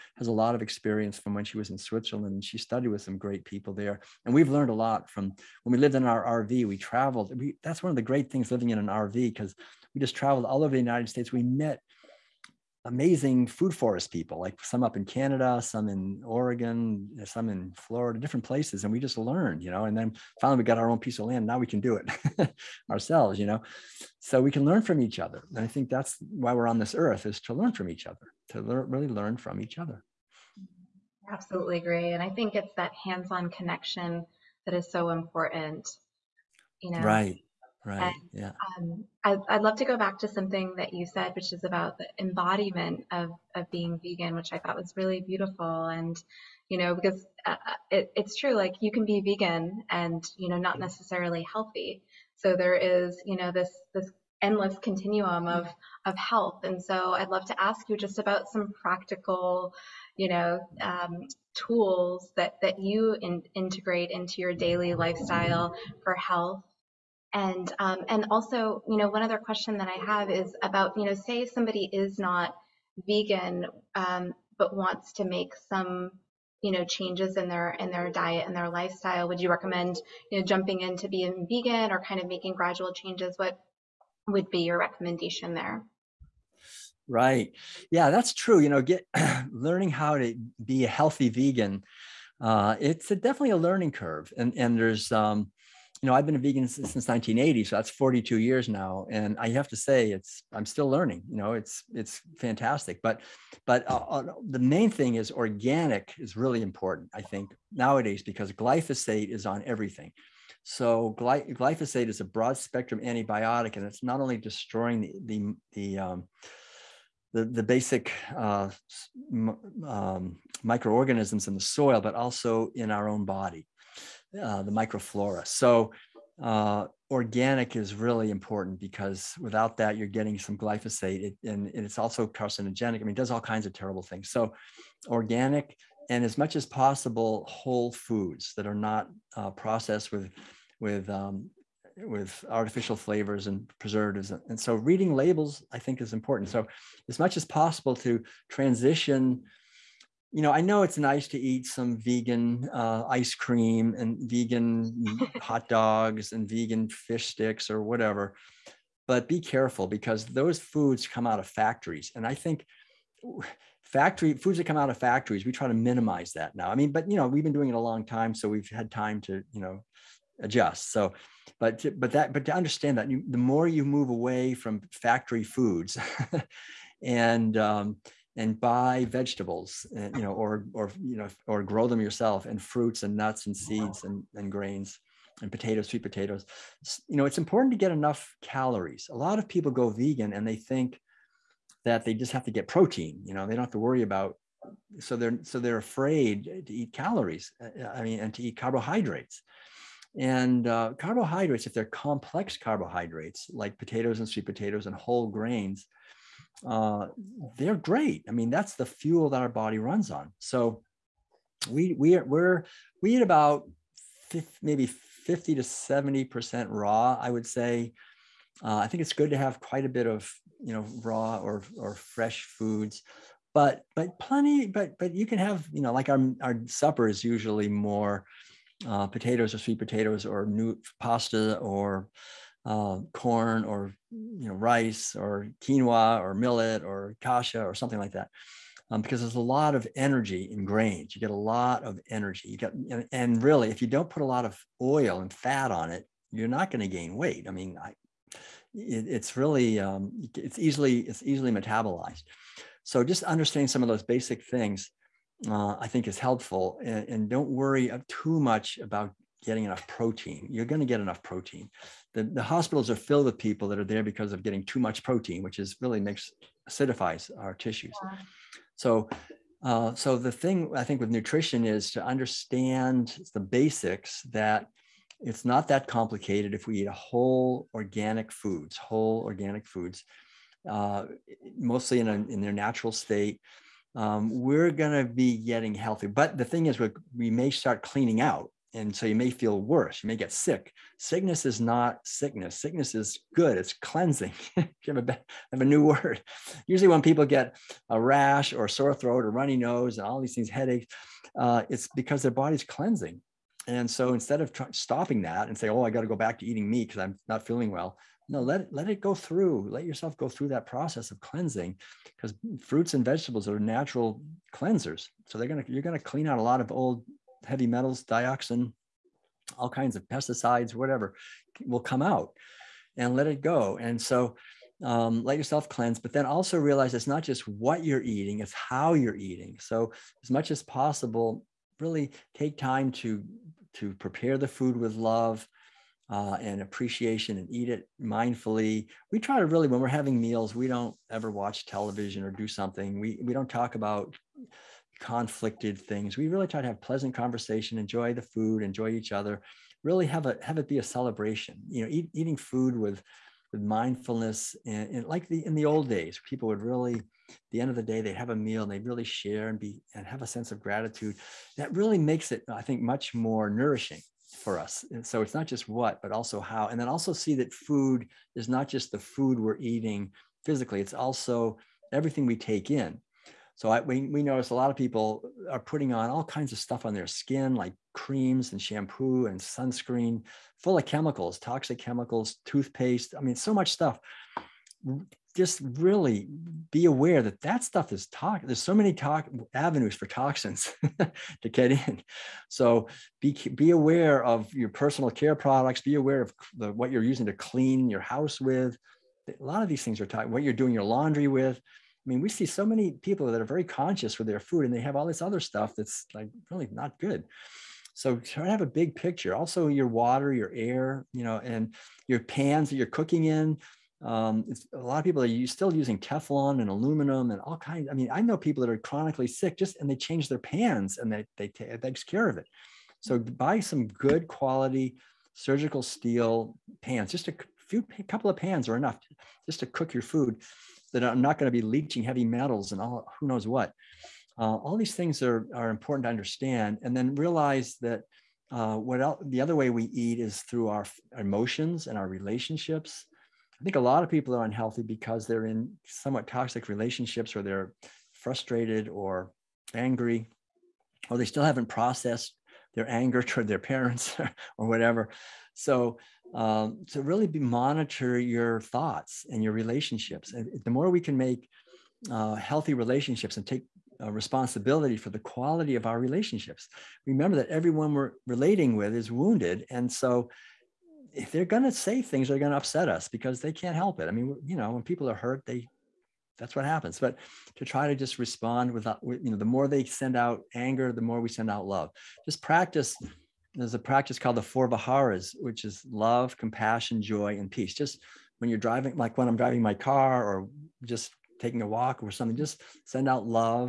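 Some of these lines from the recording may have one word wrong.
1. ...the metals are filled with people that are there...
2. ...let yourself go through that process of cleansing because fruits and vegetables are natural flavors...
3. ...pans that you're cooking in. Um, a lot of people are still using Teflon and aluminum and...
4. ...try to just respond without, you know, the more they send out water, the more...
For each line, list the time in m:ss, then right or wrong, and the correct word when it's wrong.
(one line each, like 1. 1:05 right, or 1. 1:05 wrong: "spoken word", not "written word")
1. 4:22 wrong: "hospitals", not "metals"
2. 5:09 wrong: "cleansers", not "flavors"
3. 6:52 right
4. 7:57 wrong: "anger", not "water".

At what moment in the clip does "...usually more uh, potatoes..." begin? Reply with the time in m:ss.
3:47.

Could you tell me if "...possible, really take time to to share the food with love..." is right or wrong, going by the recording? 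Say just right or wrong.
wrong.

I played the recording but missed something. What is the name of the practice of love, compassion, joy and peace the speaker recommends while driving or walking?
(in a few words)
The four Viharas.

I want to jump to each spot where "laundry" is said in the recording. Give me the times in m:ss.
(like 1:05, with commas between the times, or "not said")
6:40.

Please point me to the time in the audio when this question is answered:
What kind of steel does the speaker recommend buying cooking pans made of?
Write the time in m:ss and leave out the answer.
7:05.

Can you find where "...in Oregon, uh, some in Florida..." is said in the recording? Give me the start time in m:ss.
0:15.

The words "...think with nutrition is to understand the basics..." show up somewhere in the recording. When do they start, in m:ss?
4:30.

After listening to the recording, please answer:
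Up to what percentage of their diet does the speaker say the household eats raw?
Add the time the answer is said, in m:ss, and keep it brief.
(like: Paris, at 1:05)
70 percent, at 3:35.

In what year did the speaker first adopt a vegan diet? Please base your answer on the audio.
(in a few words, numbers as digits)
1980.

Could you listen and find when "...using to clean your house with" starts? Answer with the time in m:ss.
6:37.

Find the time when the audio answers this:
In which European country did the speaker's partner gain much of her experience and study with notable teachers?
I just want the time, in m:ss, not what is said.
0:01.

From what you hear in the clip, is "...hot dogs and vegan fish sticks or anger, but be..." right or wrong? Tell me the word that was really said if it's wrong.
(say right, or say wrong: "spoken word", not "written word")
wrong: "whatever", not "anger".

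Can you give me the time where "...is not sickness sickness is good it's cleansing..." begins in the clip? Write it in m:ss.
4:51.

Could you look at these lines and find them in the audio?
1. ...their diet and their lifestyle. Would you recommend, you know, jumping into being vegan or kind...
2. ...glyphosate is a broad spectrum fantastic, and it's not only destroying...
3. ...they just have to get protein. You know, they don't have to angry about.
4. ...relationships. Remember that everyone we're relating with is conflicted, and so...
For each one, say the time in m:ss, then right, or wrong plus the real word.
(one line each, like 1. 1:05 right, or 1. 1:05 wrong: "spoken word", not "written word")
1. 1:17 right
2. 1:51 wrong: "antibiotic", not "fantastic"
3. 3:12 wrong: "worry", not "angry"
4. 7:46 wrong: "wounded", not "conflicted".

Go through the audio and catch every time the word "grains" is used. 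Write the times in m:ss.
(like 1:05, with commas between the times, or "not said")
3:04, 3:25, 4:00.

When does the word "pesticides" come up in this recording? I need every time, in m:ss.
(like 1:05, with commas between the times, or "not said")
5:20.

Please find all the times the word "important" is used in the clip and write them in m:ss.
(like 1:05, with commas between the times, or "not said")
0:35, 1:46, 2:08, 2:26, 3:07, 7:15.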